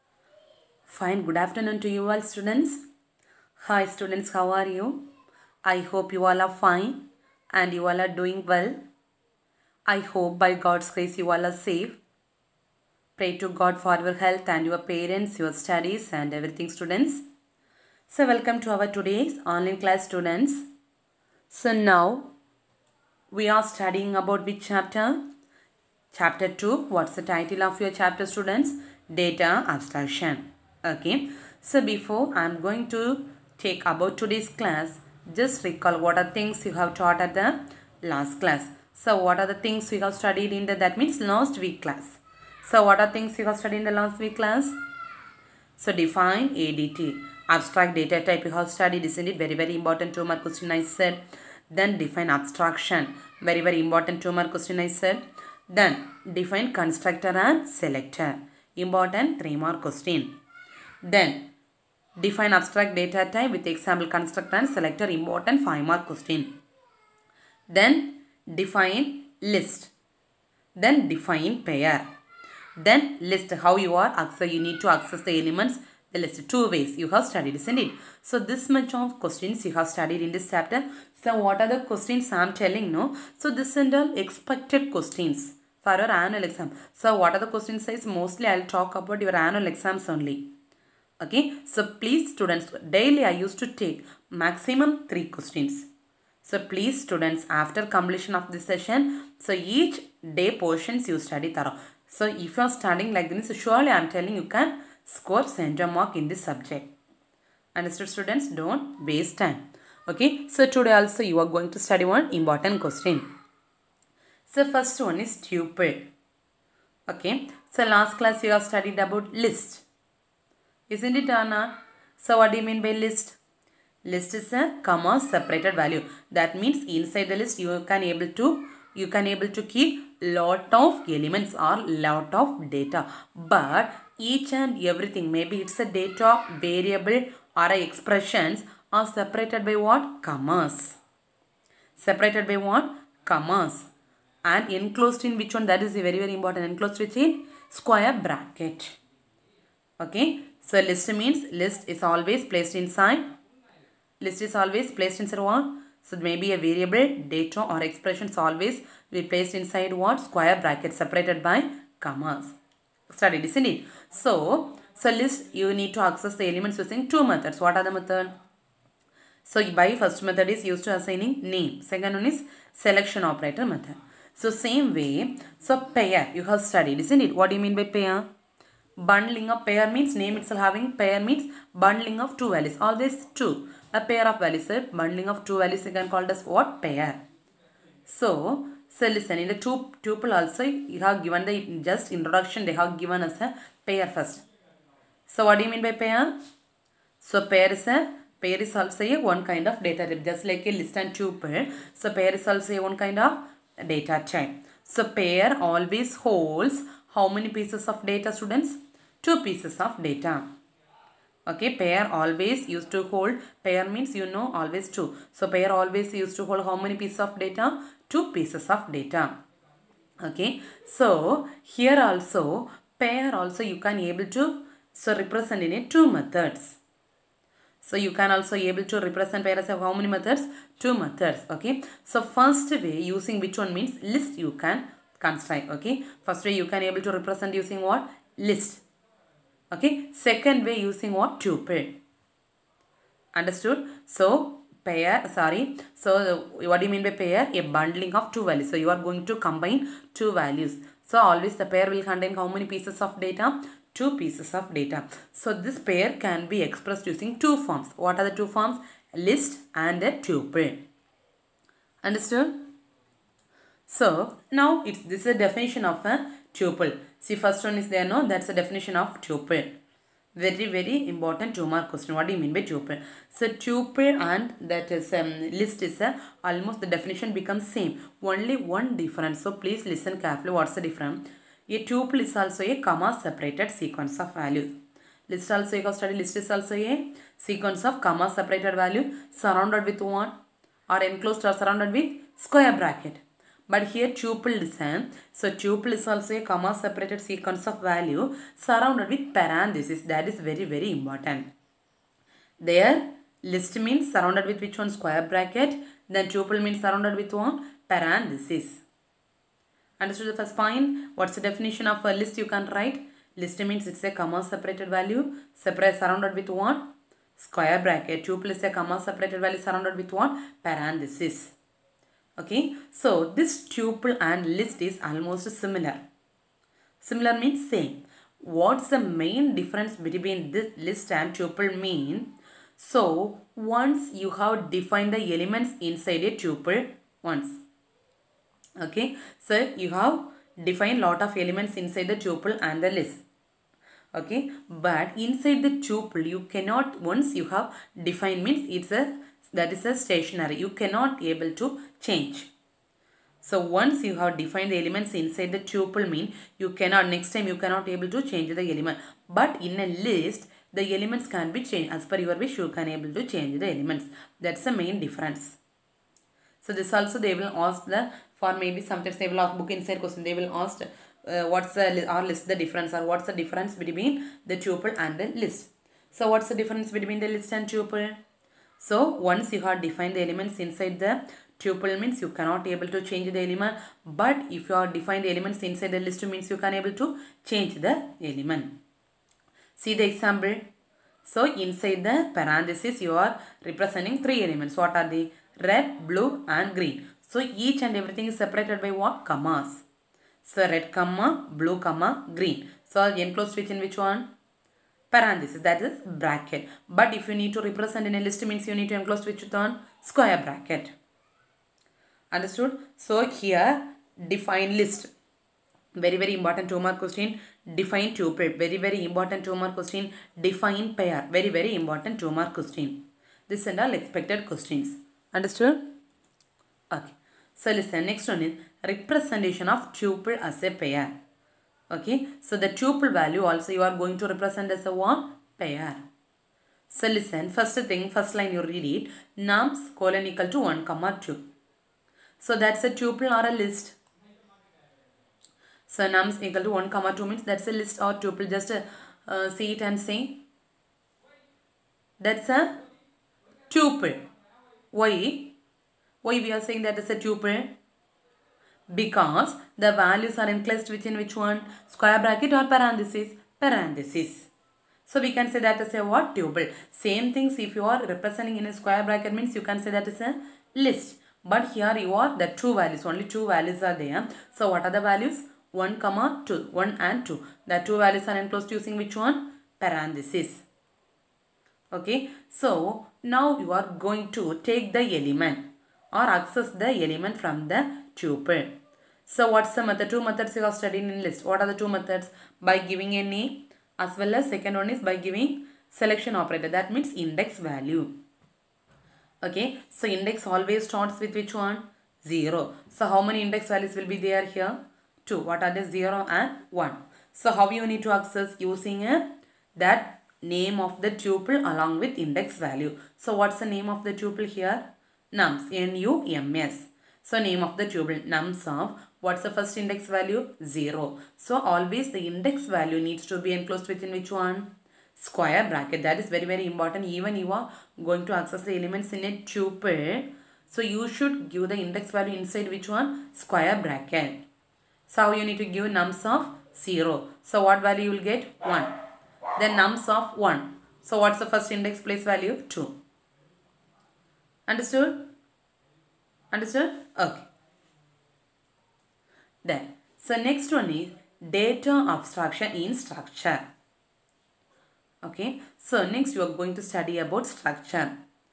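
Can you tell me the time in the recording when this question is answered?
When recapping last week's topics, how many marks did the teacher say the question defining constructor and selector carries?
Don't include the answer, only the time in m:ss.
0:59.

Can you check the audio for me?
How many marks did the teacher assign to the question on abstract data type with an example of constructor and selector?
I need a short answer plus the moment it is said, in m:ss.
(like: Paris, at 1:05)
5, at 1:05.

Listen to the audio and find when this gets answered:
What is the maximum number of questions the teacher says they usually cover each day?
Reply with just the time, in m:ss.
1:34.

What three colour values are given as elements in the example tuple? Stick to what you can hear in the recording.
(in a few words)
Red, blue and green.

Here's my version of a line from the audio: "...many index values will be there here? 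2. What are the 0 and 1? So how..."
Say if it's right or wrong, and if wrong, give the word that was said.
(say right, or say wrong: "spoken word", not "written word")
right.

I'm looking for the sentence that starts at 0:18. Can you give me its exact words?
So welcome to our today's online class students.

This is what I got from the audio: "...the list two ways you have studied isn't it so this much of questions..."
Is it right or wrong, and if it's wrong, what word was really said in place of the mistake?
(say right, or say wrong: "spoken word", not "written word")
right.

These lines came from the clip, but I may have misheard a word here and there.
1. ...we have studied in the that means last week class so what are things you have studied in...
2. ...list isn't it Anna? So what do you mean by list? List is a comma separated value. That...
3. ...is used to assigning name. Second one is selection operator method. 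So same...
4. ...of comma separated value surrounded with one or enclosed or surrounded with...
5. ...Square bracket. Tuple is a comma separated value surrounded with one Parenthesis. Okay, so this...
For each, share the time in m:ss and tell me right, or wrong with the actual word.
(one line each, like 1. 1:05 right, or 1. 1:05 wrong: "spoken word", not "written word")
1. 0:39 right
2. 1:59 right
3. 2:50 right
4. 4:47 right
5. 5:17 right.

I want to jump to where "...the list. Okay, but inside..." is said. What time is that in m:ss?
5:42.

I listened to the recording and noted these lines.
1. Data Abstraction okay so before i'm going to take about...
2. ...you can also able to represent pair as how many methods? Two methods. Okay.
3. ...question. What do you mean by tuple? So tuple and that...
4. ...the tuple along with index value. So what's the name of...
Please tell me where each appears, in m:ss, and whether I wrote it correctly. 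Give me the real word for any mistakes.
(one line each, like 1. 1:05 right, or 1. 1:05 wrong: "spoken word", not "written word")
1. 0:29 right
2. 3:47 right
3. 4:31 right
4. 8:31 right.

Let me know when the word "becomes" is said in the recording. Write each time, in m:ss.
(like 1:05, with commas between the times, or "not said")
4:37.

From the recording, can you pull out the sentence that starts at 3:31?
Okay, pair always used to hold, pair means you know always two.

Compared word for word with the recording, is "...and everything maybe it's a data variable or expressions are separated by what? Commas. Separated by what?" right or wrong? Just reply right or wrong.
right.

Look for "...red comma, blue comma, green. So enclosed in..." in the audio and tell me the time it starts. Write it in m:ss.
6:40.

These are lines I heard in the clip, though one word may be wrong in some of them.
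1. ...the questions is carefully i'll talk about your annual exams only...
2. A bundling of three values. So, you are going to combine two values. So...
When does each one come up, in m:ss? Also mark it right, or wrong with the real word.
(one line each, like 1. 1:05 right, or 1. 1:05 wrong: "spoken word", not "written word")
1. 1:27 wrong: "mostly", not "carefully"
2. 4:07 wrong: "two", not "three".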